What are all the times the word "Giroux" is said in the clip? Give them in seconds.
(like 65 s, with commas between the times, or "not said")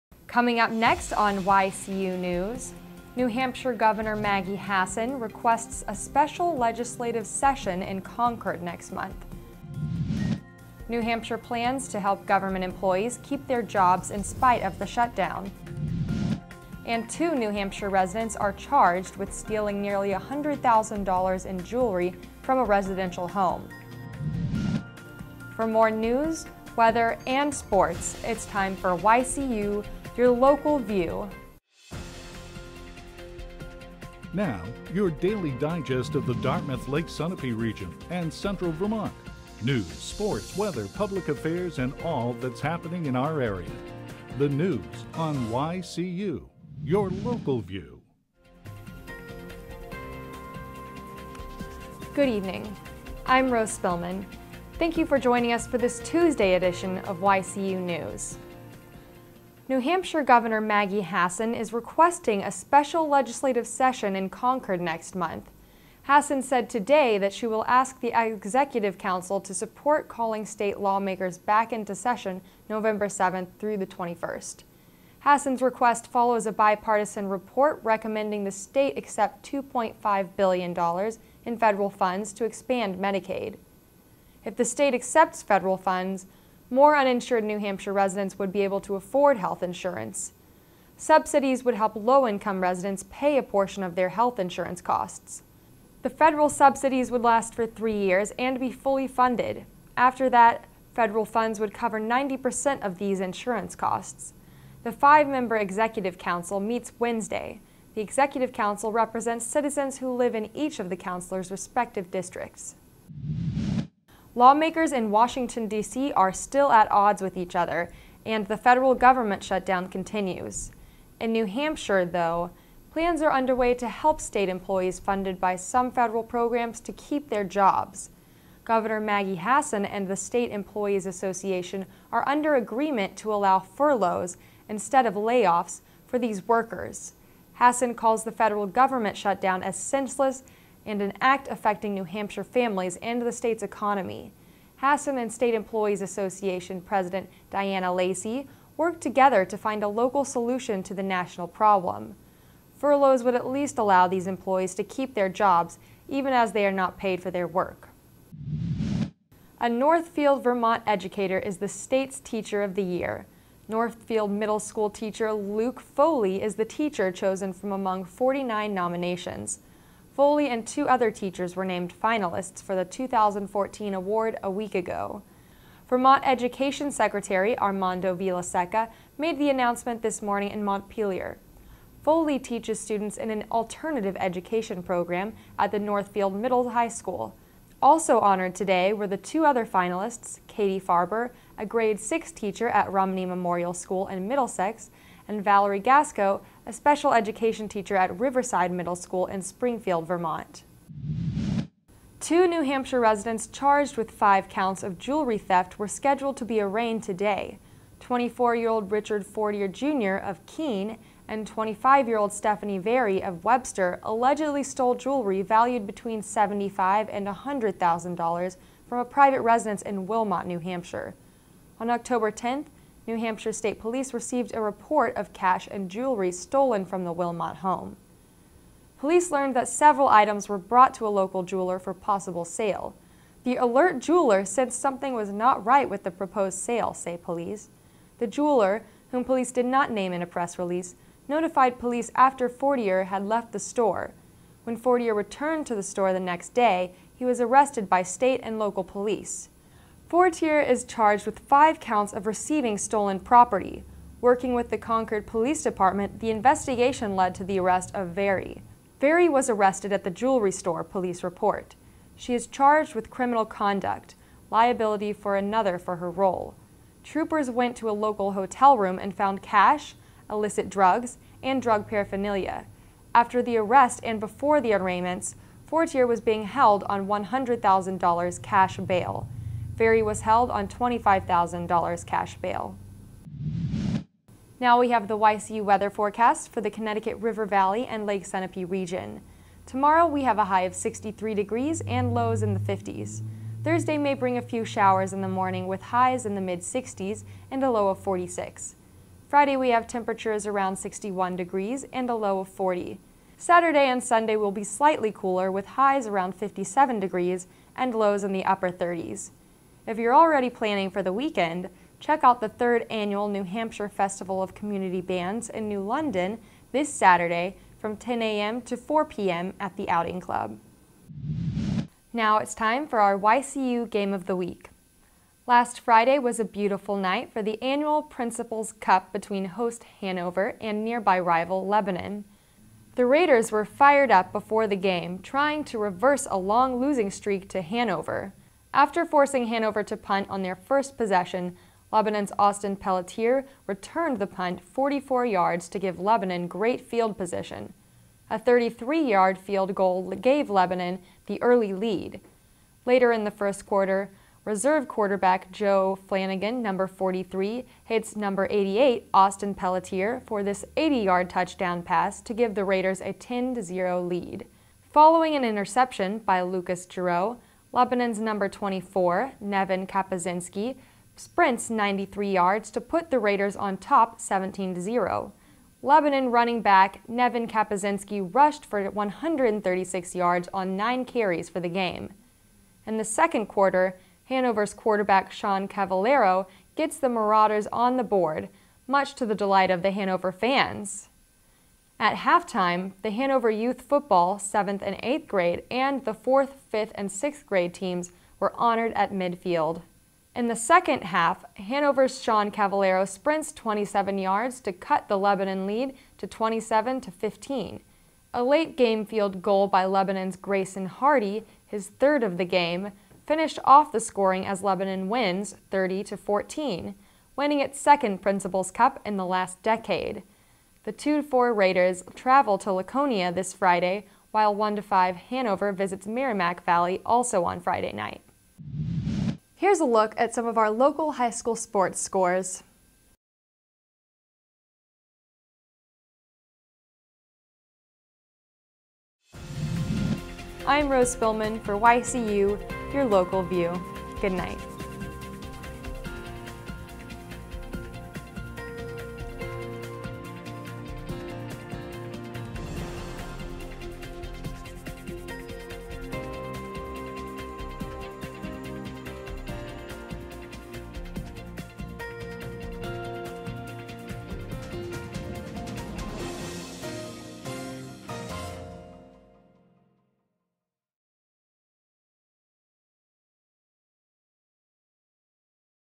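366 s.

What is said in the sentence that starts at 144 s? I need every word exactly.
Hassan and State Employees Association President Diana Lacey worked together to find a local solution to the national problem.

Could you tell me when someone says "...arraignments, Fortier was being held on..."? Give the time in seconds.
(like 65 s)
274 s.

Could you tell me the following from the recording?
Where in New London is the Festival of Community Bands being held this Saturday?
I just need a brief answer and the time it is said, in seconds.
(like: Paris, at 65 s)
The Outing Club, at 319 s.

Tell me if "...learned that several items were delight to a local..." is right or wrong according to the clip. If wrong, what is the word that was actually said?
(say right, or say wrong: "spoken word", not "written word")
wrong: "brought", not "delight".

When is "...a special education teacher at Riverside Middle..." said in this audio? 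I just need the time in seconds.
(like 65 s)
196 s.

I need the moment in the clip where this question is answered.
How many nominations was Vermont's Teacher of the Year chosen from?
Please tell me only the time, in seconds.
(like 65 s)
168 s.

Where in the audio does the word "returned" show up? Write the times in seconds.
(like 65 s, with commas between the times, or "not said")
245 s, 343 s.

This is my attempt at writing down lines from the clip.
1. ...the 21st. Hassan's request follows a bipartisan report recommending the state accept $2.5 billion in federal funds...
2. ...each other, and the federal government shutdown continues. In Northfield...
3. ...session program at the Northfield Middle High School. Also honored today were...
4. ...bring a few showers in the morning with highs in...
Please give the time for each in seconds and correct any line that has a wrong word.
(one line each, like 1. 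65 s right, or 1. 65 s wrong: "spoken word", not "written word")
1. 73 s right
2. 117 s wrong: "New", not "Northfield"
3. 184 s wrong: "education", not "session"
4. 294 s right.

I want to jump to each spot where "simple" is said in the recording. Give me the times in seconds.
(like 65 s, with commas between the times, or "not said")
not said.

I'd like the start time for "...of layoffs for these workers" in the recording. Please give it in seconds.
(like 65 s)
135 s.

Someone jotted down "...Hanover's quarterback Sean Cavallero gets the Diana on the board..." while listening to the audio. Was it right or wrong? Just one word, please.
wrong.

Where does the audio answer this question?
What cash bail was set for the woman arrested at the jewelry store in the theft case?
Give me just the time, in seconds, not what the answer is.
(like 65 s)
280 s.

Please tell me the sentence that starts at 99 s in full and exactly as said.
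After that, federal funds would cover 90% of these insurance costs.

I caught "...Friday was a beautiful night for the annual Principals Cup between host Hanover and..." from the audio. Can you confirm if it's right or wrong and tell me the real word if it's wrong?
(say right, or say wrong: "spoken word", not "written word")
right.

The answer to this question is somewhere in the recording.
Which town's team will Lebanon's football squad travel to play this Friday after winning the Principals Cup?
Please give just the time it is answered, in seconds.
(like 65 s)
422 s.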